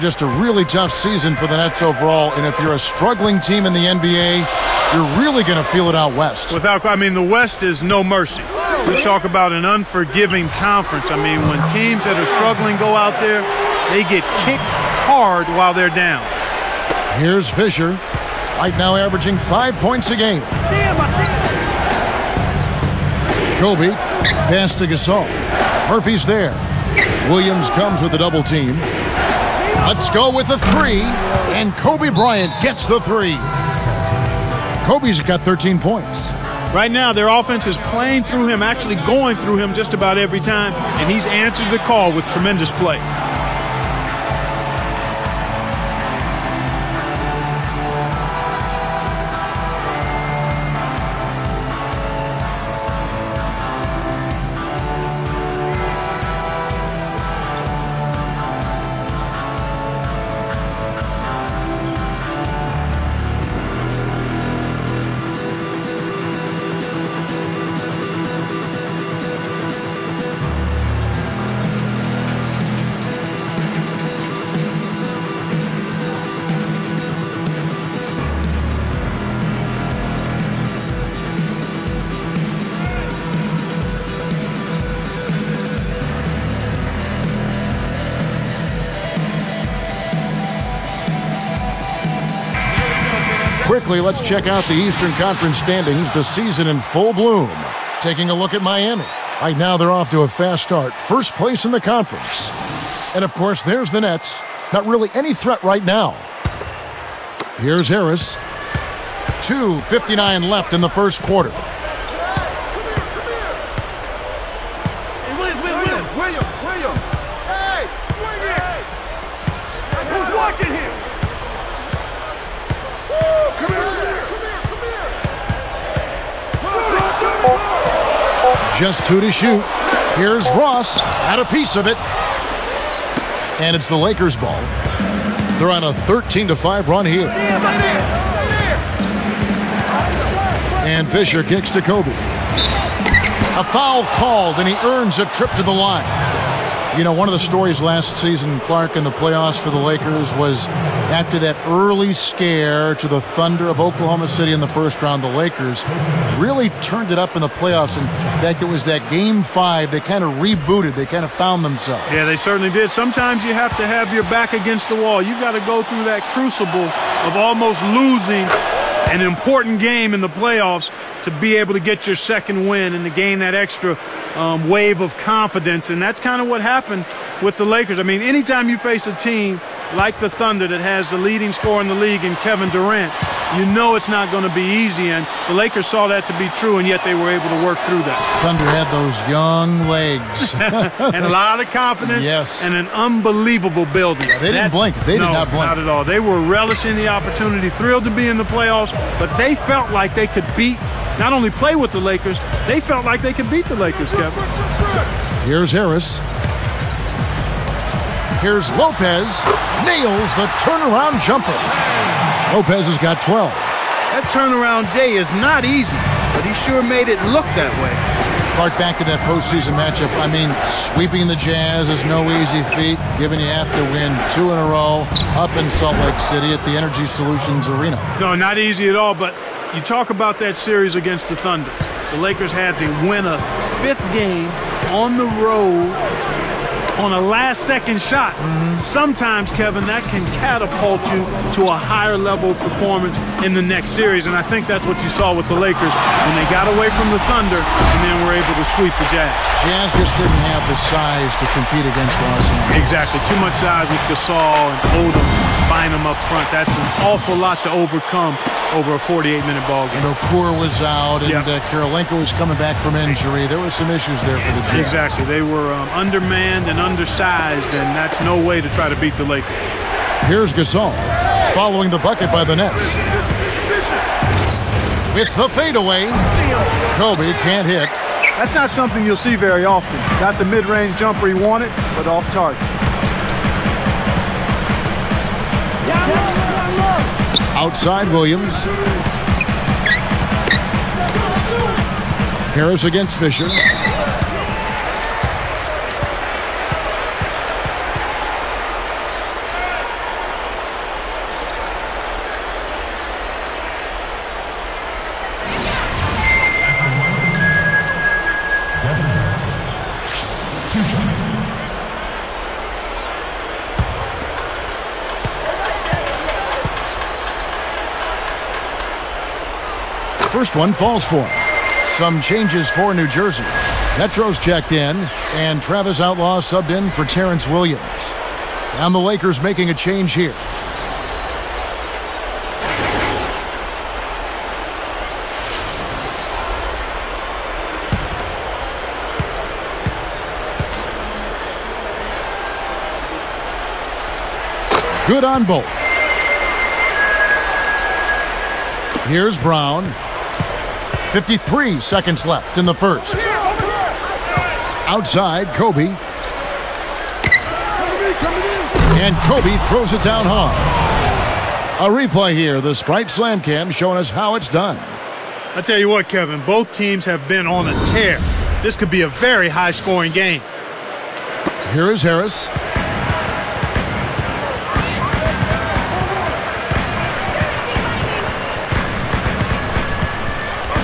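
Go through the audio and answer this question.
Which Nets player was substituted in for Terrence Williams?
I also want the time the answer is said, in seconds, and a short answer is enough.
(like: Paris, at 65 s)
Travis Outlaw, at 325 s.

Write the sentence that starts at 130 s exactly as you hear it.
Here's Ross, had a piece of it.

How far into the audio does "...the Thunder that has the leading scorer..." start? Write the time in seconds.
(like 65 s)
180 s.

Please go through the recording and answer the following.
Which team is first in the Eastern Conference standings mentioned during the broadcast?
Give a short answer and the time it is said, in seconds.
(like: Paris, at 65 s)
Miami, at 98 s.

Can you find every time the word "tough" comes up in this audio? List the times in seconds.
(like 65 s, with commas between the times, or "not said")
0 s.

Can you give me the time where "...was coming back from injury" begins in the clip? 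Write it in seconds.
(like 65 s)
262 s.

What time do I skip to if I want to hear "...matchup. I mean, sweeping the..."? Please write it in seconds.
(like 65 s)
219 s.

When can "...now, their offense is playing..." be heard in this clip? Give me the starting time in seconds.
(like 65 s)
36 s.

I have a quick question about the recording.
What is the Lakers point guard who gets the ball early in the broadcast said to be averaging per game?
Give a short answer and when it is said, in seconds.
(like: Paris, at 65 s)
5 points, at 19 s.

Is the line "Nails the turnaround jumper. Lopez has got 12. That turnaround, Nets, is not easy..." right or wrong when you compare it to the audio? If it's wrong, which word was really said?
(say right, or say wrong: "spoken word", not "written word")
wrong: "Jay", not "Nets".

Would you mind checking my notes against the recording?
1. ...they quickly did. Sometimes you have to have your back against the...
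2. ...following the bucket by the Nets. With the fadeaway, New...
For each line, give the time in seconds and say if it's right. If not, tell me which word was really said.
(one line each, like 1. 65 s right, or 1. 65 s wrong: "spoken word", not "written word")
1. 162 s wrong: "certainly", not "quickly"
2. 271 s wrong: "Kobe", not "New".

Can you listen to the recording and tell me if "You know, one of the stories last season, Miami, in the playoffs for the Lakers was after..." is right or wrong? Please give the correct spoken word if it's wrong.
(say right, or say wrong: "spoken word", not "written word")
wrong: "Clark", not "Miami".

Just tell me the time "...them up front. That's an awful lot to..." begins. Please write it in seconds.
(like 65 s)
255 s.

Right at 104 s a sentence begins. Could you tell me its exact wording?
Not really any threat right now.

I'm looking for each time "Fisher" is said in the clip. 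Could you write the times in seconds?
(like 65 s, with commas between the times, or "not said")
17 s, 141 s, 293 s.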